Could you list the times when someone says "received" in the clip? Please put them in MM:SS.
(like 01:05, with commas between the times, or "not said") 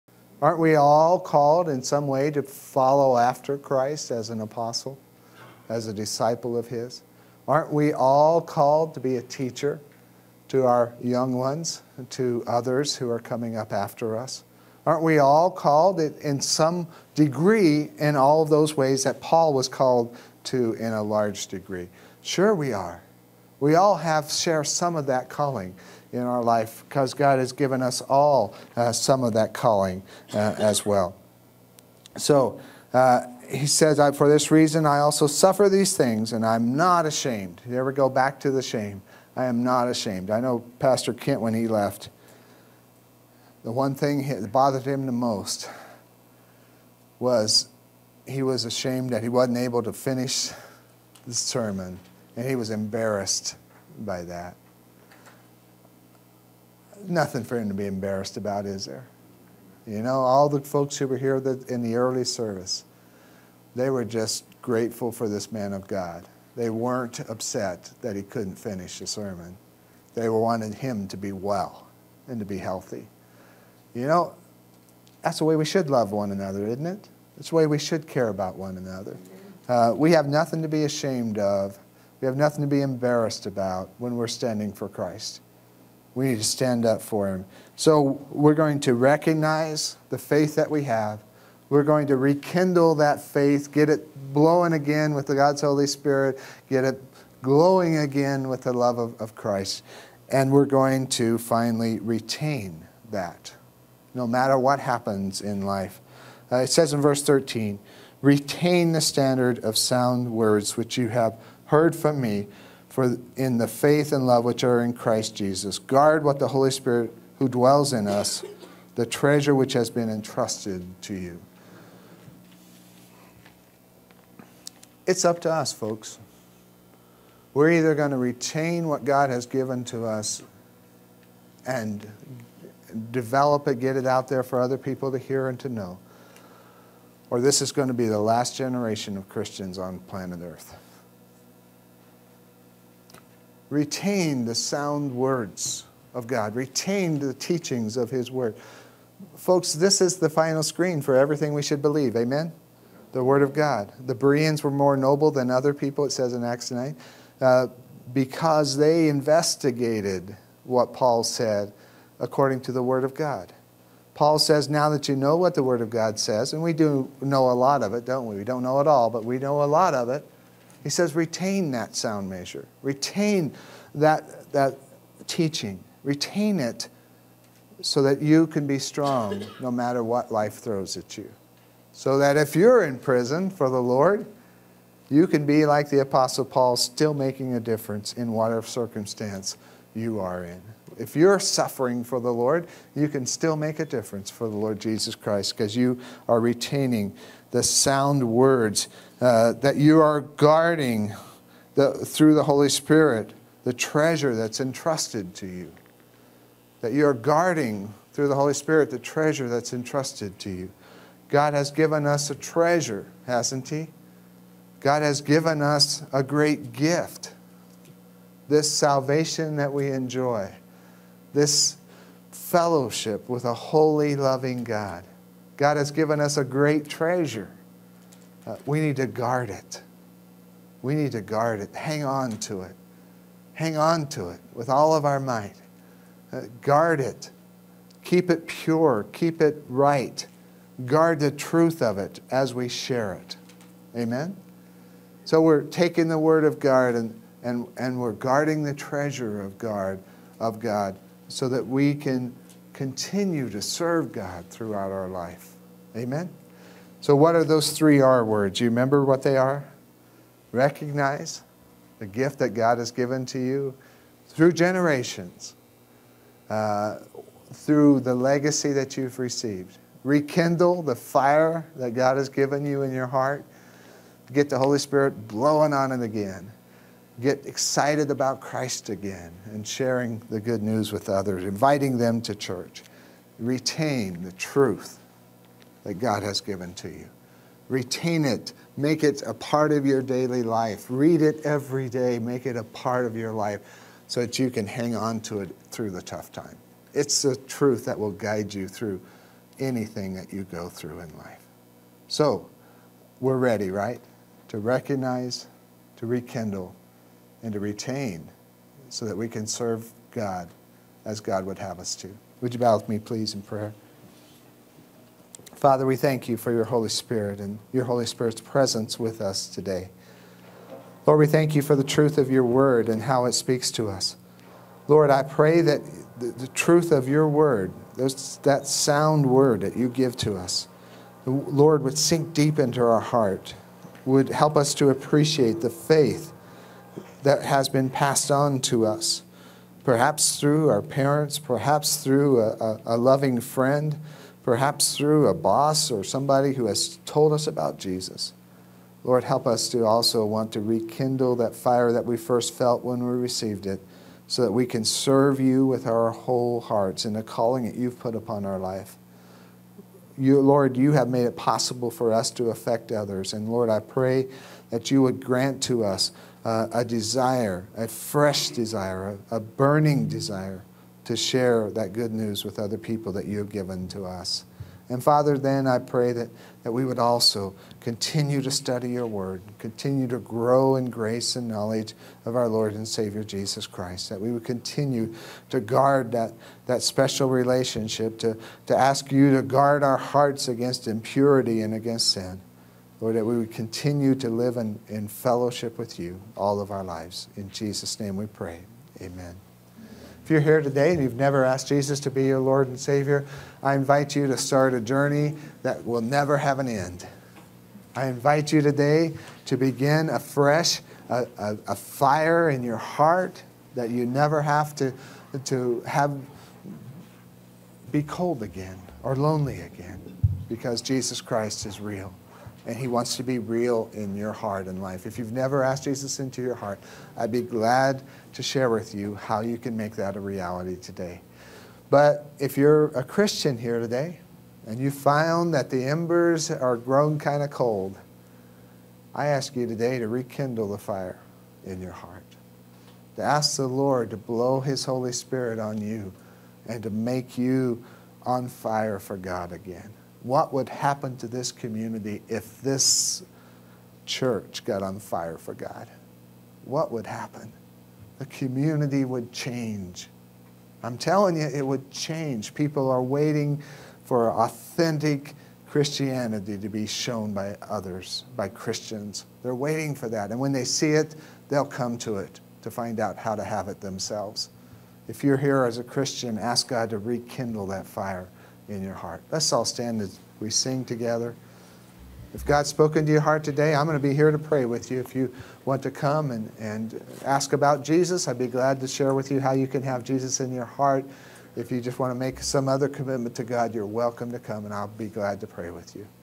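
04:29, 05:53.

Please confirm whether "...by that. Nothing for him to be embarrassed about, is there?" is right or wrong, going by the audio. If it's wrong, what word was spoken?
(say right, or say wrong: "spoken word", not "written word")
right.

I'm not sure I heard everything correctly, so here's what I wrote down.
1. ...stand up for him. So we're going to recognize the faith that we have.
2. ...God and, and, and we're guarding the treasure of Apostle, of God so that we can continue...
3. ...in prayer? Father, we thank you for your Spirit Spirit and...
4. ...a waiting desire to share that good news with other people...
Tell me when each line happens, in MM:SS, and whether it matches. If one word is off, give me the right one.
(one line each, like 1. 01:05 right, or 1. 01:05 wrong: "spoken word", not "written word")
1. 01:26 right
2. 04:06 wrong: "God", not "Apostle"
3. 05:13 wrong: "Holy", not "Spirit"
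4. 06:09 wrong: "burning", not "waiting".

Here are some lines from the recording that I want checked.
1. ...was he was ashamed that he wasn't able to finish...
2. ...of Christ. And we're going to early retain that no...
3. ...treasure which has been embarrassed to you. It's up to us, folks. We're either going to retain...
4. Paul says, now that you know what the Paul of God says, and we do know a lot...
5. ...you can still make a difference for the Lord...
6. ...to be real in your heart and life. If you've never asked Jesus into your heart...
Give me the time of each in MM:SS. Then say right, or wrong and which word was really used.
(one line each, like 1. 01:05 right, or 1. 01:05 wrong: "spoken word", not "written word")
1. 00:47 right
2. 01:39 wrong: "finally", not "early"
3. 01:59 wrong: "entrusted", not "embarrassed"
4. 02:44 wrong: "Word", not "Paul"
5. 03:12 right
6. 07:03 right.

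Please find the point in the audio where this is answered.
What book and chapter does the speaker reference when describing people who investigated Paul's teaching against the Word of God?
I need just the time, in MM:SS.
02:36.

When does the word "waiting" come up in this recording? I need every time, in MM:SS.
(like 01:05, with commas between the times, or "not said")
07:43, 07:49.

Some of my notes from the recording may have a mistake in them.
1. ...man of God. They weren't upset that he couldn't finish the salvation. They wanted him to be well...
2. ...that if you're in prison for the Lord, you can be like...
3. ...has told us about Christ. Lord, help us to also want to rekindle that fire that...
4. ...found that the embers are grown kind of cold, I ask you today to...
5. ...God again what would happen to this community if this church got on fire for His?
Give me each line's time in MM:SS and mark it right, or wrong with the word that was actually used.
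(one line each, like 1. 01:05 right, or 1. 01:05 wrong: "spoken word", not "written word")
1. 01:05 wrong: "sermon", not "salvation"
2. 03:02 right
3. 05:46 wrong: "Jesus", not "Christ"
4. 07:14 right
5. 07:29 wrong: "God", not "His".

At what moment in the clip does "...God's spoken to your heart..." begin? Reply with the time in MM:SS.
08:02.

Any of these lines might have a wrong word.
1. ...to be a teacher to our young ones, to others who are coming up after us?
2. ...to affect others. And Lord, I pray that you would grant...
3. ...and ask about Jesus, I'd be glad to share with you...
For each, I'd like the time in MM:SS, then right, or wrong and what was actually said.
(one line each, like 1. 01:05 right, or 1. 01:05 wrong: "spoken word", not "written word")
1. 00:08 right
2. 06:02 right
3. 08:06 right.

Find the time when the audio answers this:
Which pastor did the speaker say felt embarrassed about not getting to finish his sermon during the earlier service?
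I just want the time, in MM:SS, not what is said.
00:40.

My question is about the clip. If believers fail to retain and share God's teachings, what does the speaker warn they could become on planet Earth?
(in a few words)
the last generation of Christians.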